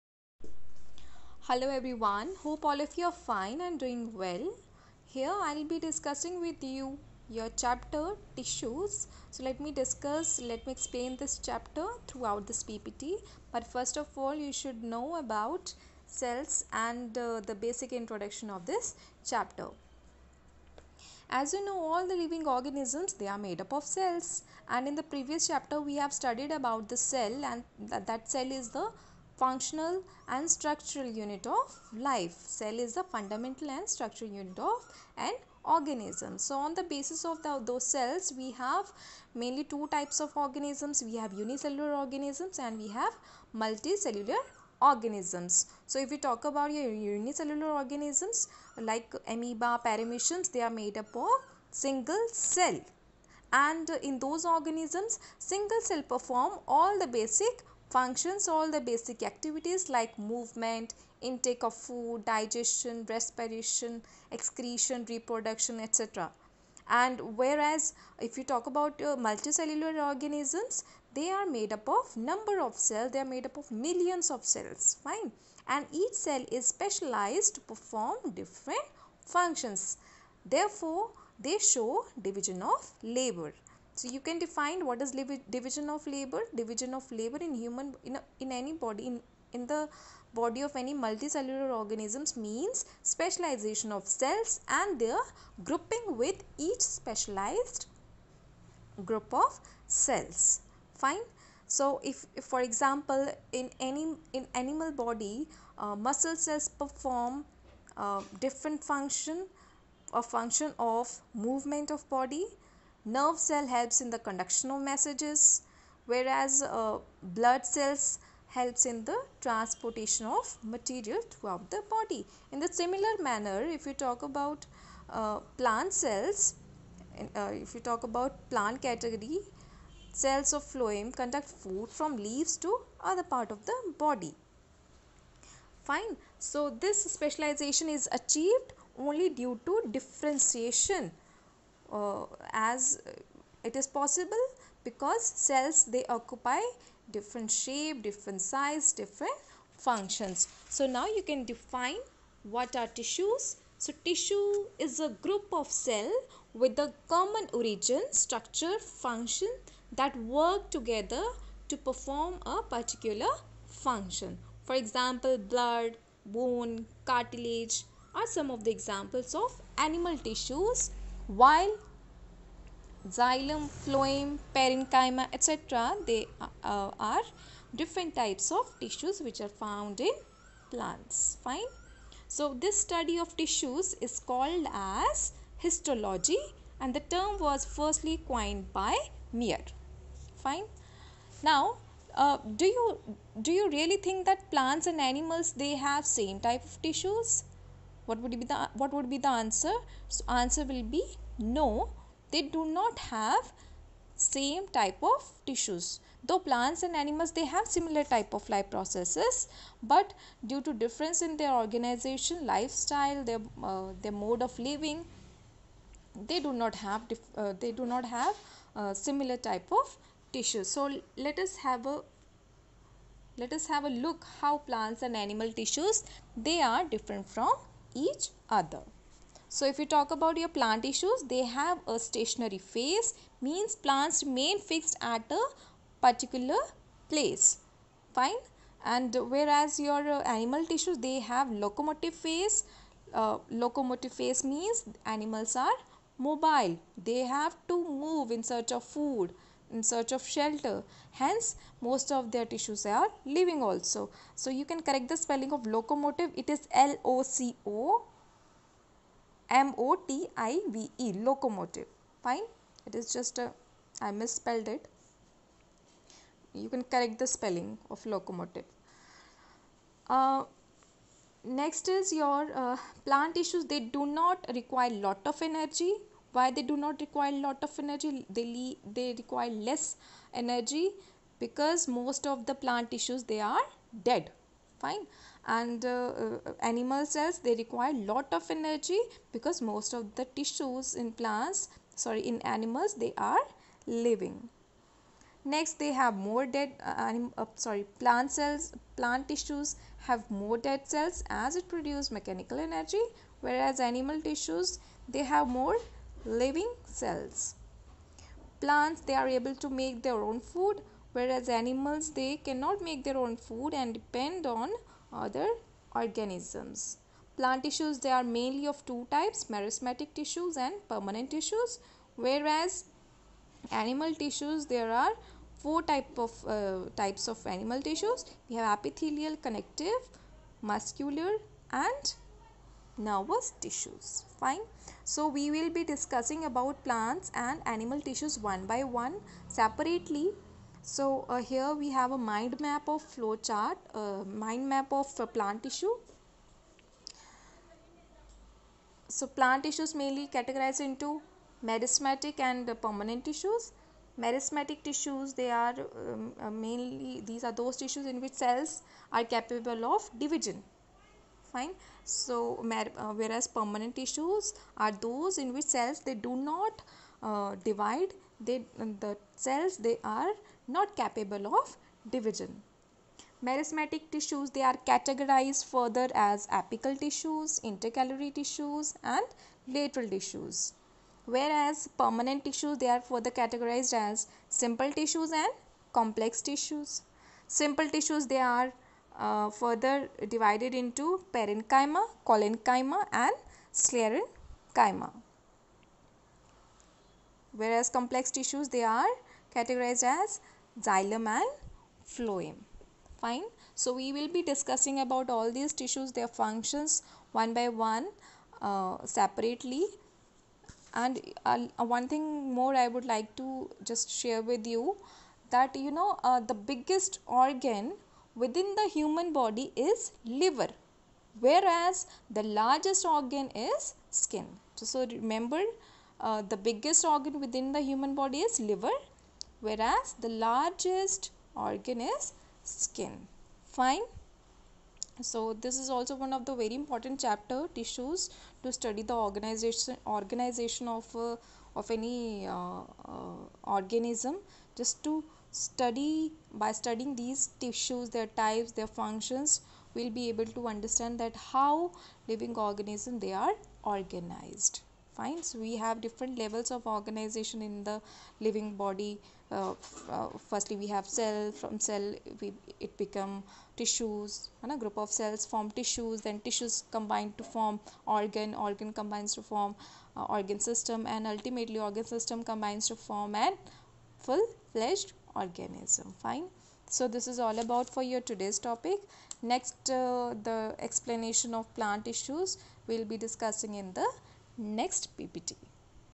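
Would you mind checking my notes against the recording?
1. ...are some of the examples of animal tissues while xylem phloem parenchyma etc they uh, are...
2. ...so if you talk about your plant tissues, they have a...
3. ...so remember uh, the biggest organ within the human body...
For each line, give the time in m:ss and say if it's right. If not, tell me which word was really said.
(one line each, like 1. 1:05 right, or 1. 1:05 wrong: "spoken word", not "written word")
1. 2:48 right
2. 3:49 right
3. 7:04 right.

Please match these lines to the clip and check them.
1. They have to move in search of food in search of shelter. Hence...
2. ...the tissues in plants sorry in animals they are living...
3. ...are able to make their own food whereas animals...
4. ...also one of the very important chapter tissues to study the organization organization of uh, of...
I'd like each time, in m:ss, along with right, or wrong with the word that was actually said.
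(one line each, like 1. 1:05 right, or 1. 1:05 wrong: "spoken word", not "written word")
1. 4:07 right
2. 4:50 right
3. 5:09 right
4. 7:15 right.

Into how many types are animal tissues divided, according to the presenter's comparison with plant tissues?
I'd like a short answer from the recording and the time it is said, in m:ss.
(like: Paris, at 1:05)
4, at 5:25.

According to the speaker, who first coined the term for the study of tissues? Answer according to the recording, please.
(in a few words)
Mayer.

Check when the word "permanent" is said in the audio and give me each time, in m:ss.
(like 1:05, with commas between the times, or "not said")
5:20, 5:52, 6:03, 6:21.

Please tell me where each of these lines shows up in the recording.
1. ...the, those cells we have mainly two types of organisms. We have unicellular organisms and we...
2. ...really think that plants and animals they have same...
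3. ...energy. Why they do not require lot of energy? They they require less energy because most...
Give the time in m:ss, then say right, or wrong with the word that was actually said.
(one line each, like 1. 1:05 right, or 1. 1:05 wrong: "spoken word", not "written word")
1. 0:37 right
2. 3:13 right
3. 4:35 right.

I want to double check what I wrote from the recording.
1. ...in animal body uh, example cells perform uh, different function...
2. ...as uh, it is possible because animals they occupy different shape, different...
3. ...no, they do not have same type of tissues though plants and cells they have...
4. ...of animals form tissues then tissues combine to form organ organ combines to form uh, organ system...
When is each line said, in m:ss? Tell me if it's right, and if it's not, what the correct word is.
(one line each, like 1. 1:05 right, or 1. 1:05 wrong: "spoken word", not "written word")
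1. 1:44 wrong: "muscle", not "example"
2. 2:22 wrong: "cells", not "animals"
3. 3:21 wrong: "animals", not "cells"
4. 7:44 wrong: "cells", not "animals".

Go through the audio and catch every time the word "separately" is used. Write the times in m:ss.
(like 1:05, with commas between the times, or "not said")
5:39, 6:49.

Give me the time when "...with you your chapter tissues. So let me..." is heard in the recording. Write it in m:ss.
0:06.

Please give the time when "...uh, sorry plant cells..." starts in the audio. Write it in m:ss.
4:57.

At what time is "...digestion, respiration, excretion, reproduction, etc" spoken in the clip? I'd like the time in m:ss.
1:02.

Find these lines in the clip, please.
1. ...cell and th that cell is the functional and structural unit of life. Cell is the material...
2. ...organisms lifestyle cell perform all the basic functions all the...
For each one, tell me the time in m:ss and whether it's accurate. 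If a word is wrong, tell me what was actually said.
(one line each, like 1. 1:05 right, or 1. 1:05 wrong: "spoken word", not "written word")
1. 0:27 wrong: "fundamental", not "material"
2. 0:54 wrong: "single", not "lifestyle".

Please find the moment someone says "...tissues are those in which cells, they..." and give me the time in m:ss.
6:03.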